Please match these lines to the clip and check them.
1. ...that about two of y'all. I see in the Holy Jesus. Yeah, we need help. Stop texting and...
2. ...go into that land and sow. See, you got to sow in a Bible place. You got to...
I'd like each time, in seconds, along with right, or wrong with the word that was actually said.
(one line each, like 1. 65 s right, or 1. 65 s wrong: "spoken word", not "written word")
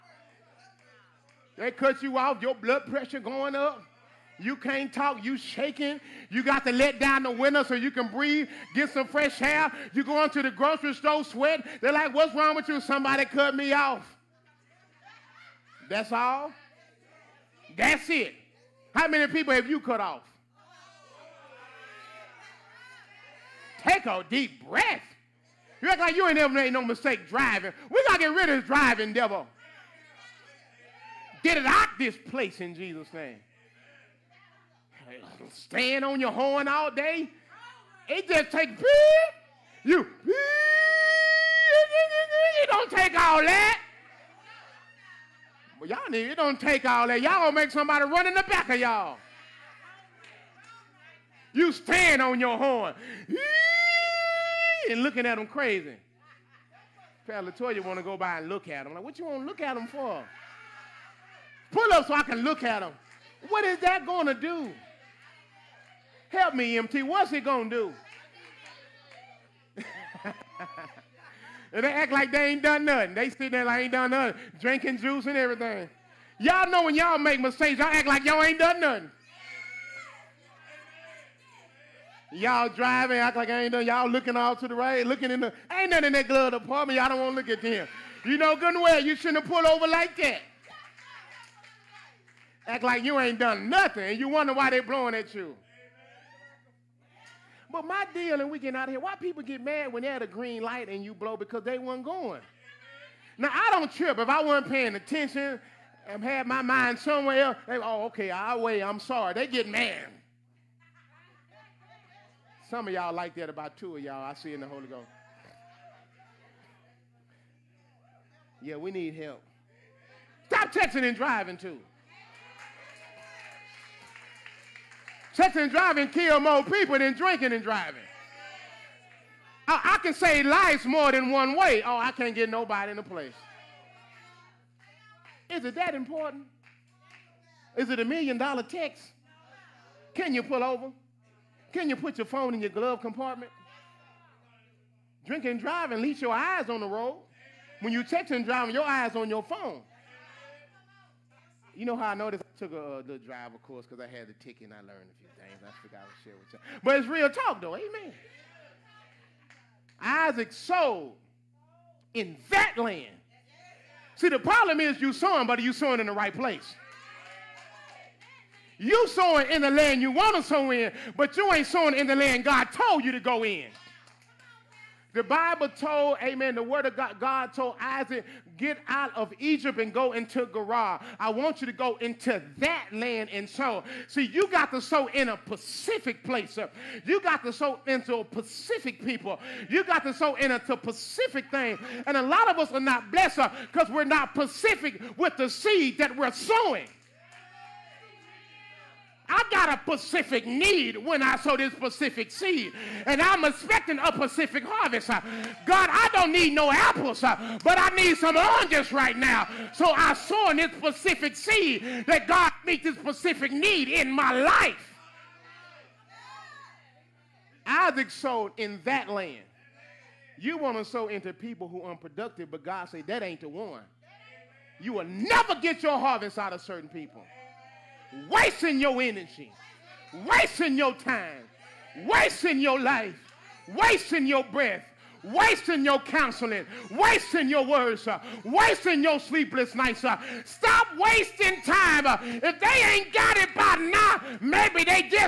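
1. 113 s wrong: "Ghost", not "Jesus"
2. 181 s wrong: "Pacific", not "Bible".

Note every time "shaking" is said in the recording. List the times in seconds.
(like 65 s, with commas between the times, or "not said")
5 s.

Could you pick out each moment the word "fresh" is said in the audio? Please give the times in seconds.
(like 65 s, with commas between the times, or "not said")
9 s.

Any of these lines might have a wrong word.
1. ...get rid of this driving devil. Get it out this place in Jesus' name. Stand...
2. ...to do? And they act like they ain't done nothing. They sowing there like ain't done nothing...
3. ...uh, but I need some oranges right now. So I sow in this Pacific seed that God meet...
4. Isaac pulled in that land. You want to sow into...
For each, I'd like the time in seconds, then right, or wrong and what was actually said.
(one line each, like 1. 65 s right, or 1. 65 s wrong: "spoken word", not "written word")
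1. 28 s right
2. 67 s wrong: "sitting", not "sowing"
3. 207 s right
4. 217 s wrong: "sowed", not "pulled".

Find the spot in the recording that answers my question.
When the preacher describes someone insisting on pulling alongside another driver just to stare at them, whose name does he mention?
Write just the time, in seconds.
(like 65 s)
57 s.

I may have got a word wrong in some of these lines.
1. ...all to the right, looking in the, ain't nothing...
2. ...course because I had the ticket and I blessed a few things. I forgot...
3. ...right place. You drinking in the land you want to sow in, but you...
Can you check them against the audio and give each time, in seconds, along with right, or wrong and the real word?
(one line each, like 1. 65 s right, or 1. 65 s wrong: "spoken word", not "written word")
1. 84 s right
2. 153 s wrong: "learned", not "blessed"
3. 166 s wrong: "sowing", not "drinking".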